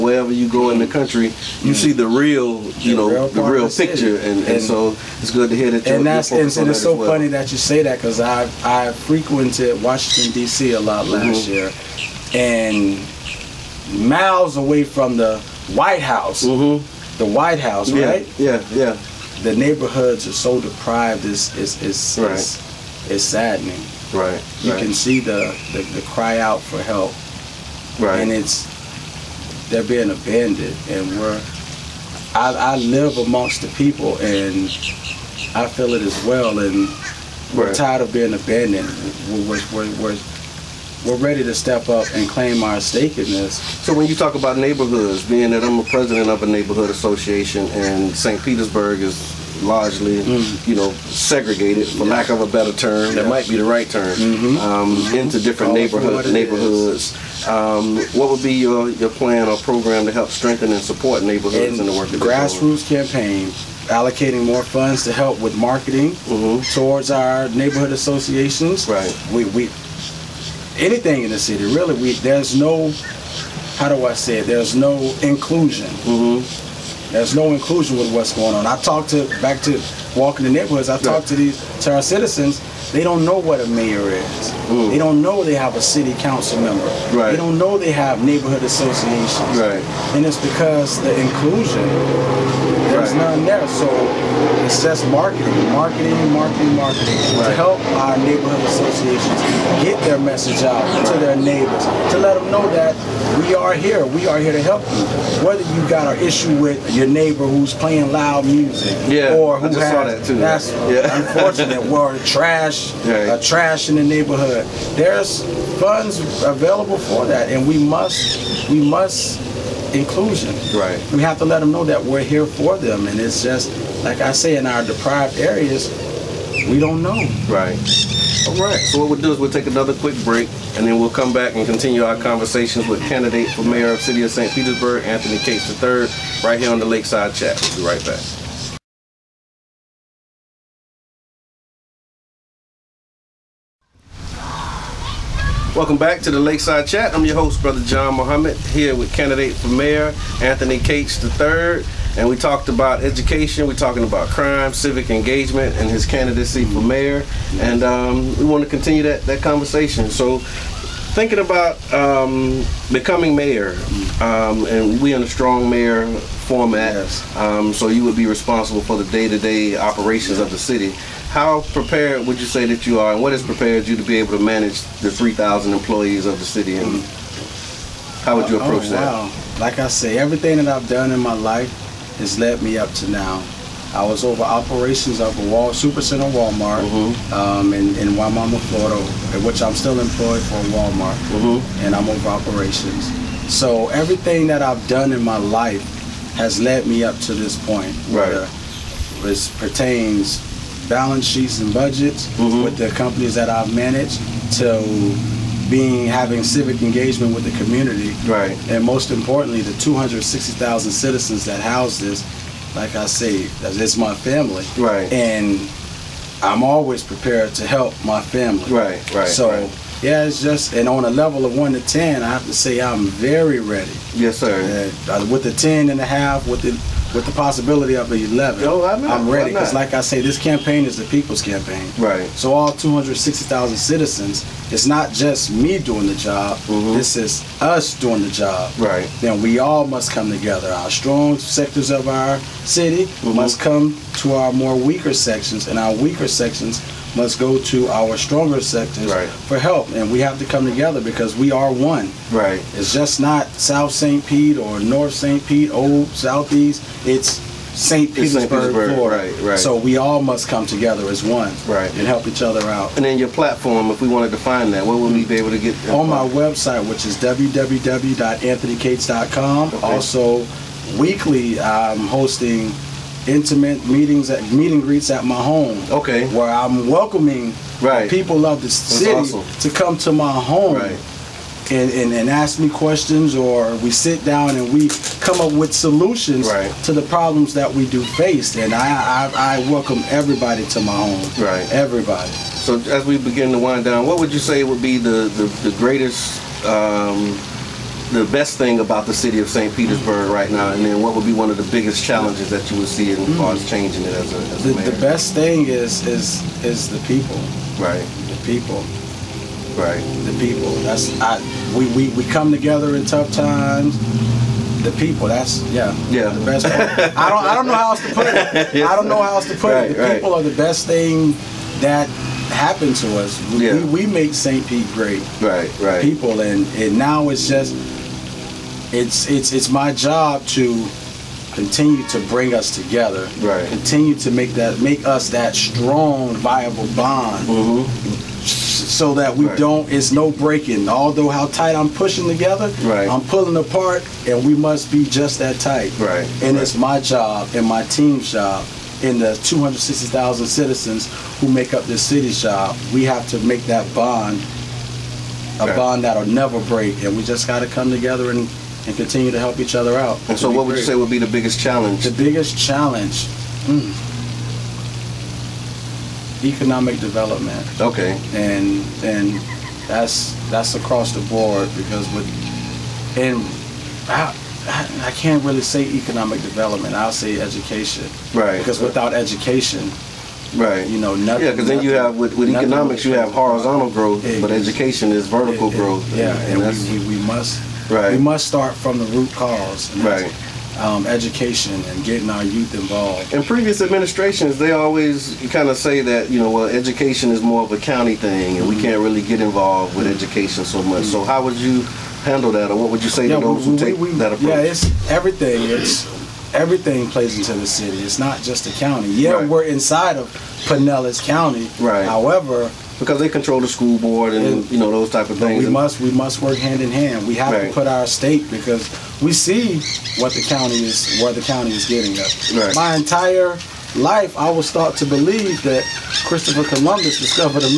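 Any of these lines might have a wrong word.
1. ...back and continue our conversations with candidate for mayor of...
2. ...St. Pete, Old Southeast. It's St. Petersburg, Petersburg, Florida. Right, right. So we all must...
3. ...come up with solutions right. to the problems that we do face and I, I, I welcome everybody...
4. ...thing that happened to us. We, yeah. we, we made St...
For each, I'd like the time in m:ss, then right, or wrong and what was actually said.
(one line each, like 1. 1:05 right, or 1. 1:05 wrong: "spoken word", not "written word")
1. 2:11 right
2. 4:15 right
3. 4:45 right
4. 5:20 right.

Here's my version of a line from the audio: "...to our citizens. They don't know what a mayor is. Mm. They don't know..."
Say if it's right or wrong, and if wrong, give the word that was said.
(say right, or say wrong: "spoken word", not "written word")
right.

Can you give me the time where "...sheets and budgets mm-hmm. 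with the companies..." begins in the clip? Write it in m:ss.
3:21.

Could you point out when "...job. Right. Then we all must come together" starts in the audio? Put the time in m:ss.
3:58.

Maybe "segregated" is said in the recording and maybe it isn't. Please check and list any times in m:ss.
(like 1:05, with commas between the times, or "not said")
0:50.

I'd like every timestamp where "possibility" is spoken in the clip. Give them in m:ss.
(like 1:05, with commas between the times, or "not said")
3:47.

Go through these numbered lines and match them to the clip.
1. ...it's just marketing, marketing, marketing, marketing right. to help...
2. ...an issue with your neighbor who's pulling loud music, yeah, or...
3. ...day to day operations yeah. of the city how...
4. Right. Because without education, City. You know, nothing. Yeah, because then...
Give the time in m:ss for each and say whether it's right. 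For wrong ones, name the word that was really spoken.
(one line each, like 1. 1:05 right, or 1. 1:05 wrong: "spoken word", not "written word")
1. 1:34 right
2. 1:46 wrong: "playing", not "pulling"
3. 2:49 right
4. 6:18 wrong: "Right", not "City".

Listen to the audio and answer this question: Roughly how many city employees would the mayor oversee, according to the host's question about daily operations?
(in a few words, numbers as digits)
3,000.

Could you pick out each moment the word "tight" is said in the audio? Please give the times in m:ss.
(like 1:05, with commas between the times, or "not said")
5:41, 5:45.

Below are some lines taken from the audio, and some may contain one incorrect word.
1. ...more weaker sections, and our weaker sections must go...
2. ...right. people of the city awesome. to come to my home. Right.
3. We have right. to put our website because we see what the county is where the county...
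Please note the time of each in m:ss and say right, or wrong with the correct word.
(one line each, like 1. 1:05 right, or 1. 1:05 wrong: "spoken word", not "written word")
1. 4:04 right
2. 4:37 right
3. 6:57 wrong: "state", not "website".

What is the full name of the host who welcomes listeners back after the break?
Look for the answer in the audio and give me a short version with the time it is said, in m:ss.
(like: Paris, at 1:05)
Brother John Muhammad, at 2:27.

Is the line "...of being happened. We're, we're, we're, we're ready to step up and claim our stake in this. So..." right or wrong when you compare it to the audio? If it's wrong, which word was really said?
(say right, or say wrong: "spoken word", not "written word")
wrong: "abandoned", not "happened".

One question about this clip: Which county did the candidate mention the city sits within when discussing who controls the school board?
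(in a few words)
Pinellas County.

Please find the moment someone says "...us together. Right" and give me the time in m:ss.
5:32.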